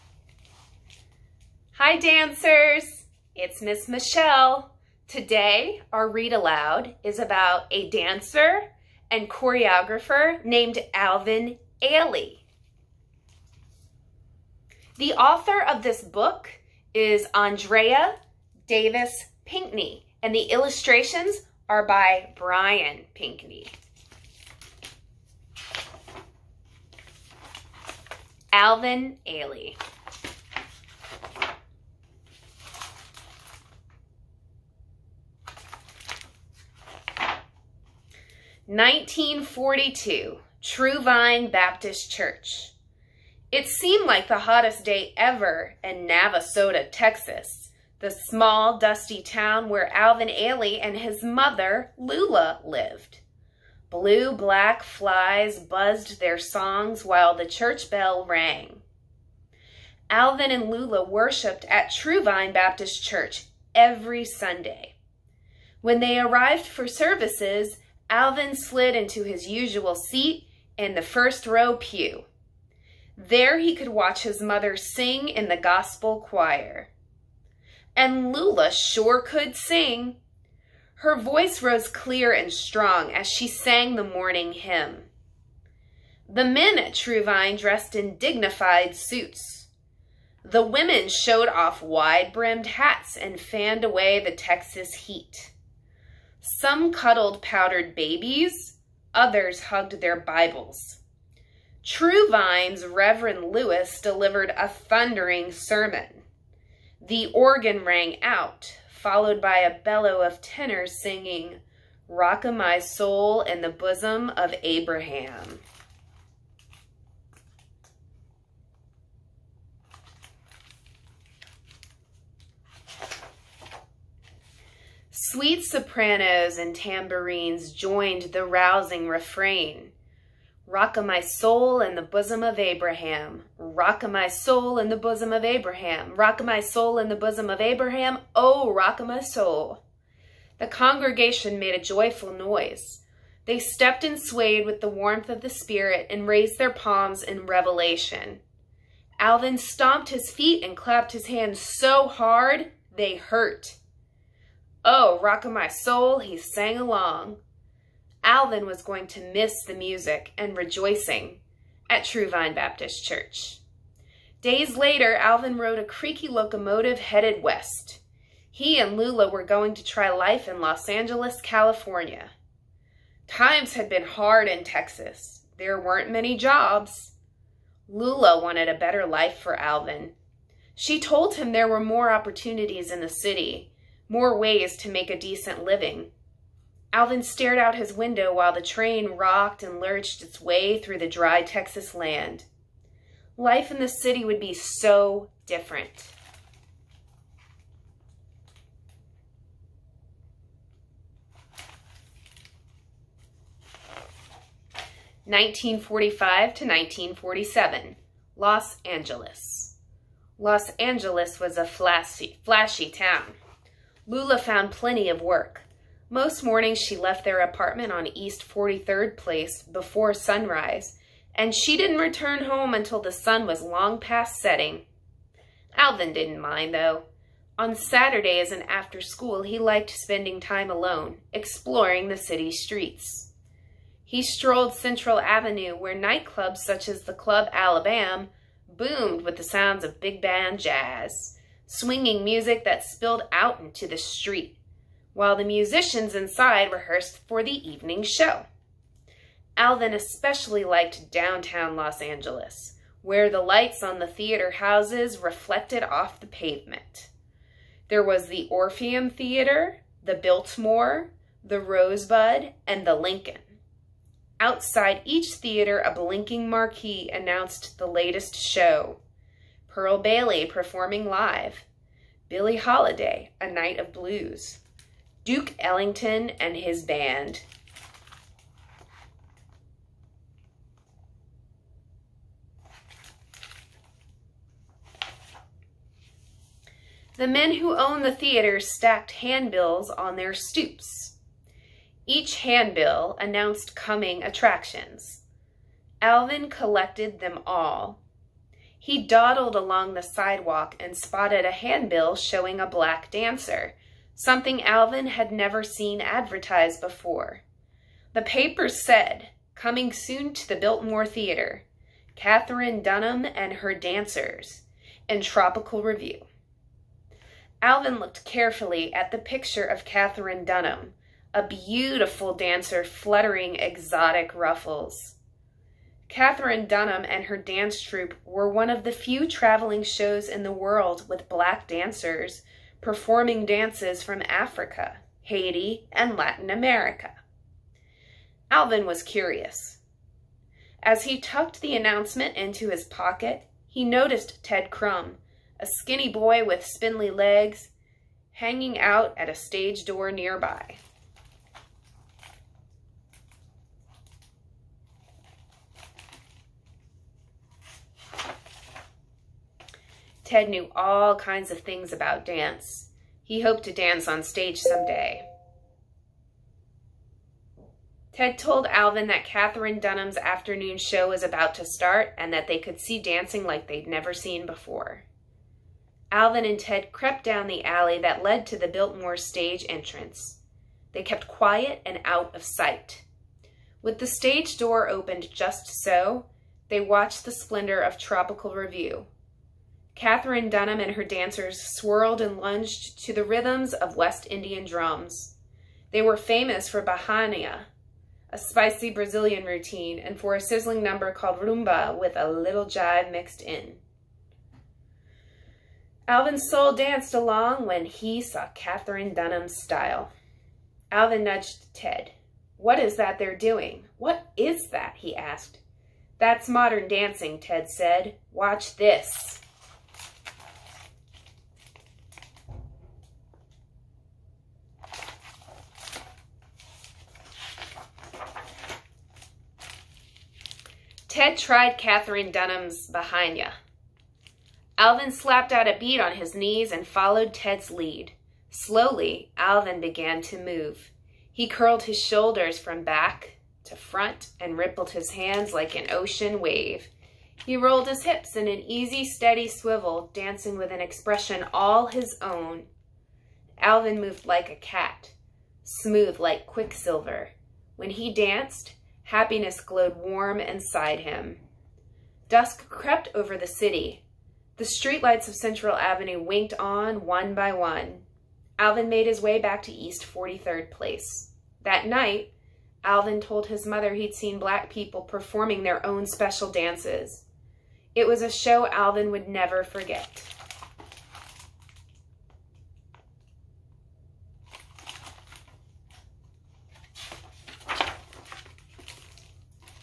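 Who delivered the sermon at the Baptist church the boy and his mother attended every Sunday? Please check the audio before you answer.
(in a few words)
Reverend Lewis.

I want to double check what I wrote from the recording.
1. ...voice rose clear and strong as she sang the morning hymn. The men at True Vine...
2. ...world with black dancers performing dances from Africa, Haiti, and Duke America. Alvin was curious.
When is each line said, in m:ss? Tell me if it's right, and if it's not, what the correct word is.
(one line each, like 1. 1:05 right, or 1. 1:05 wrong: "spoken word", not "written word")
1. 1:21 right
2. 5:30 wrong: "Latin", not "Duke".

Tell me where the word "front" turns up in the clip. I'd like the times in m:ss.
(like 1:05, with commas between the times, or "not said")
7:23.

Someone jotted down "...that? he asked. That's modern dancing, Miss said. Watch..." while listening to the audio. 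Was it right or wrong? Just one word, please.
wrong.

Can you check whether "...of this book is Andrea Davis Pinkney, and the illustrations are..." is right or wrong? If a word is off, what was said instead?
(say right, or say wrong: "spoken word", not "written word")
right.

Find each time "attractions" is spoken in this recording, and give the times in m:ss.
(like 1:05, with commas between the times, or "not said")
4:54.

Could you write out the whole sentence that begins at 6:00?
Ted knew all kinds of things about dance.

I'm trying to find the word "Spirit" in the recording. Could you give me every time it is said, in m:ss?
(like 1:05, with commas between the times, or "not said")
2:25.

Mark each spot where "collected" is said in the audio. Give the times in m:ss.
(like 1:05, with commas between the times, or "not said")
4:56.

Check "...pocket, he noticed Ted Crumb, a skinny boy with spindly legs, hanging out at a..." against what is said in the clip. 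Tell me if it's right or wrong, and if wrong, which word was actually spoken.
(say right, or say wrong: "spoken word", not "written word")
right.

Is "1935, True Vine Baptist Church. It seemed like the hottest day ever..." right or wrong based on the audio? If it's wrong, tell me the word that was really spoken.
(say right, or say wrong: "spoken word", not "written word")
wrong: "1942", not "1935".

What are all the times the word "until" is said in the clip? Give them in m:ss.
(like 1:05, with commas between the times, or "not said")
3:42.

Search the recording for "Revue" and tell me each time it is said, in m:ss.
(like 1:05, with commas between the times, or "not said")
5:15, 6:28.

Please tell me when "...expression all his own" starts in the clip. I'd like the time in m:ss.
7:30.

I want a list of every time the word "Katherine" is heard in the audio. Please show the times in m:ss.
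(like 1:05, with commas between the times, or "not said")
5:12, 5:19, 5:26, 6:09, 6:29, 6:48, 7:11.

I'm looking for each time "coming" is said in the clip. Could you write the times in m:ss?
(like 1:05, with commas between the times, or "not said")
4:53, 5:09.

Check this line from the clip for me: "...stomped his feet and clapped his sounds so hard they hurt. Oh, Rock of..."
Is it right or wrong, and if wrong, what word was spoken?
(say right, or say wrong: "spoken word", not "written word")
wrong: "hands", not "sounds".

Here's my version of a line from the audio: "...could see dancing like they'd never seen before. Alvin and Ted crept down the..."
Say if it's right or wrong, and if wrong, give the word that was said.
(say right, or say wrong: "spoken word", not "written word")
right.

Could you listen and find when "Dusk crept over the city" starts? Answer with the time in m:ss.
7:42.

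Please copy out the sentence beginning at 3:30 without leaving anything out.
Los Angeles was a flashy, flashy town.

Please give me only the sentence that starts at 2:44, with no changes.
Days later, Alvin rode a creaky locomotive headed west.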